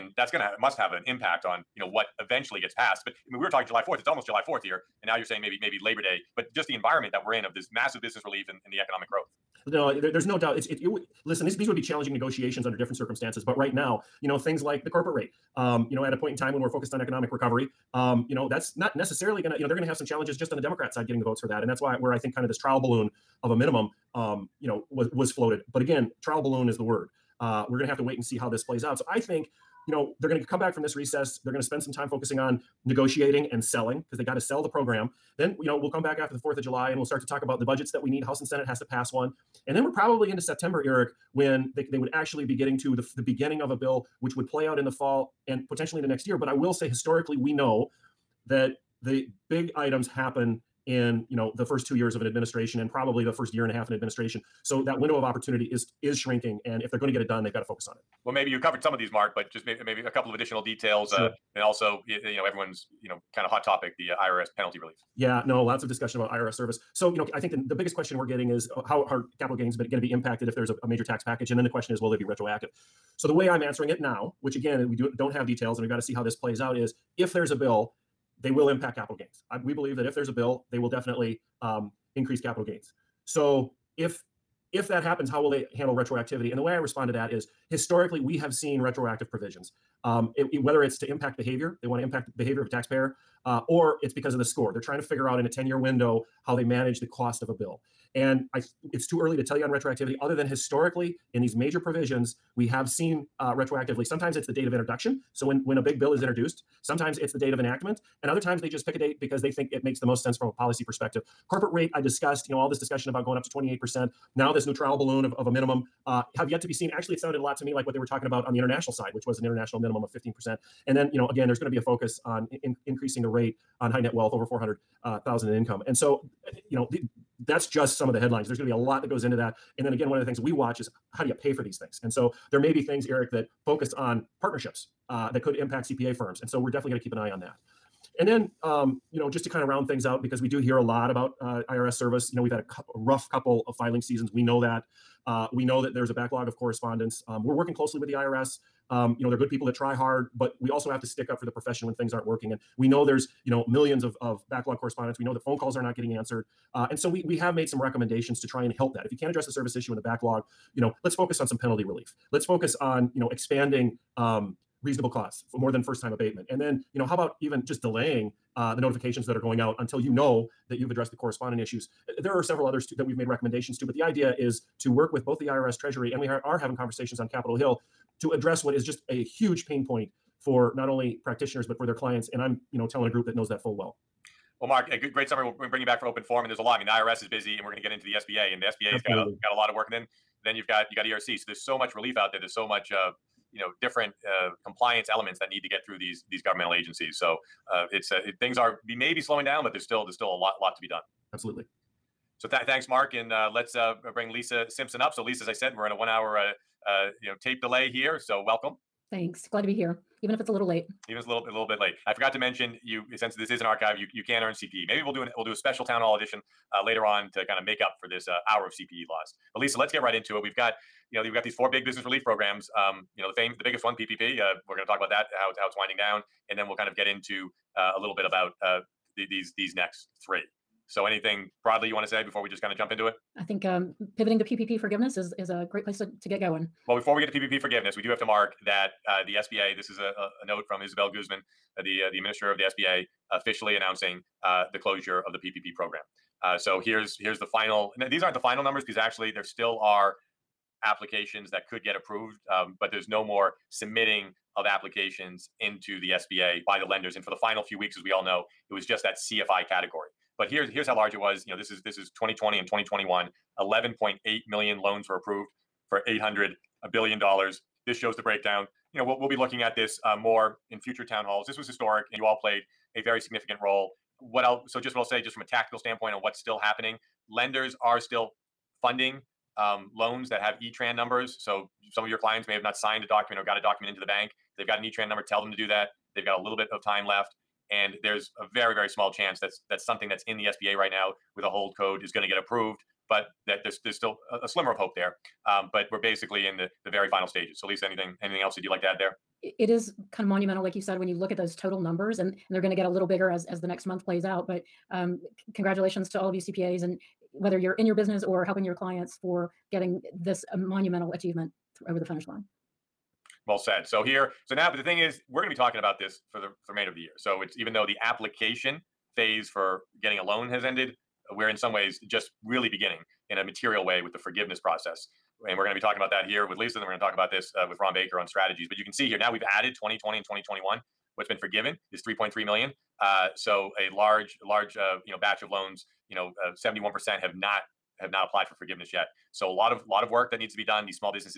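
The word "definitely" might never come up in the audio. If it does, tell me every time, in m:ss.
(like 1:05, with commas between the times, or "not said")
1:20, 2:16.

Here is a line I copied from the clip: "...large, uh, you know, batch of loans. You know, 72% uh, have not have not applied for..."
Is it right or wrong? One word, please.
wrong.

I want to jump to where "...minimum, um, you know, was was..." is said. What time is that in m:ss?
0:23.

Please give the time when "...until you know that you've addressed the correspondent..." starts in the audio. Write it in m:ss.
2:49.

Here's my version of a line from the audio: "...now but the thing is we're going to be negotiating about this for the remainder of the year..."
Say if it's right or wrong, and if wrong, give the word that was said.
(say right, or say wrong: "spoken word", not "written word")
wrong: "talking", not "negotiating".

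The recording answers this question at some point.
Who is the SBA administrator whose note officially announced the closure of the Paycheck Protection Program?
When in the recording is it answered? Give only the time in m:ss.
4:00.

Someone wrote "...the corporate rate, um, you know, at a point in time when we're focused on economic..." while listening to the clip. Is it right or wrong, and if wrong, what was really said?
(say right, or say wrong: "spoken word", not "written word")
right.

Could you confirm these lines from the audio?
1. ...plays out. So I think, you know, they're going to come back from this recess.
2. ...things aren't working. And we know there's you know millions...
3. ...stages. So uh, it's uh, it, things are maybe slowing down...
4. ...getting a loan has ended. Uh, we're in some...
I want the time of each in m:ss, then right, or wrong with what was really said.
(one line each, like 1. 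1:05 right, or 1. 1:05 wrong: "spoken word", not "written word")
1. 0:28 right
2. 2:31 right
3. 3:16 wrong: "agencies", not "stages"
4. 5:20 right.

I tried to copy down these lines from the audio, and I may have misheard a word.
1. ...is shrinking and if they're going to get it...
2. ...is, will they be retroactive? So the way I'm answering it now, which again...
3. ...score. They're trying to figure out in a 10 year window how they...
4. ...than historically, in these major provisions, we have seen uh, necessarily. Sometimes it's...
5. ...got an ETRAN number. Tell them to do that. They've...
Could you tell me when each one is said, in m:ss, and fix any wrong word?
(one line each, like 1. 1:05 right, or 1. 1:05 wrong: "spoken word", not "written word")
1. 0:56 right
2. 1:11 right
3. 1:34 right
4. 1:40 wrong: "retroactively", not "necessarily"
5. 4:44 right.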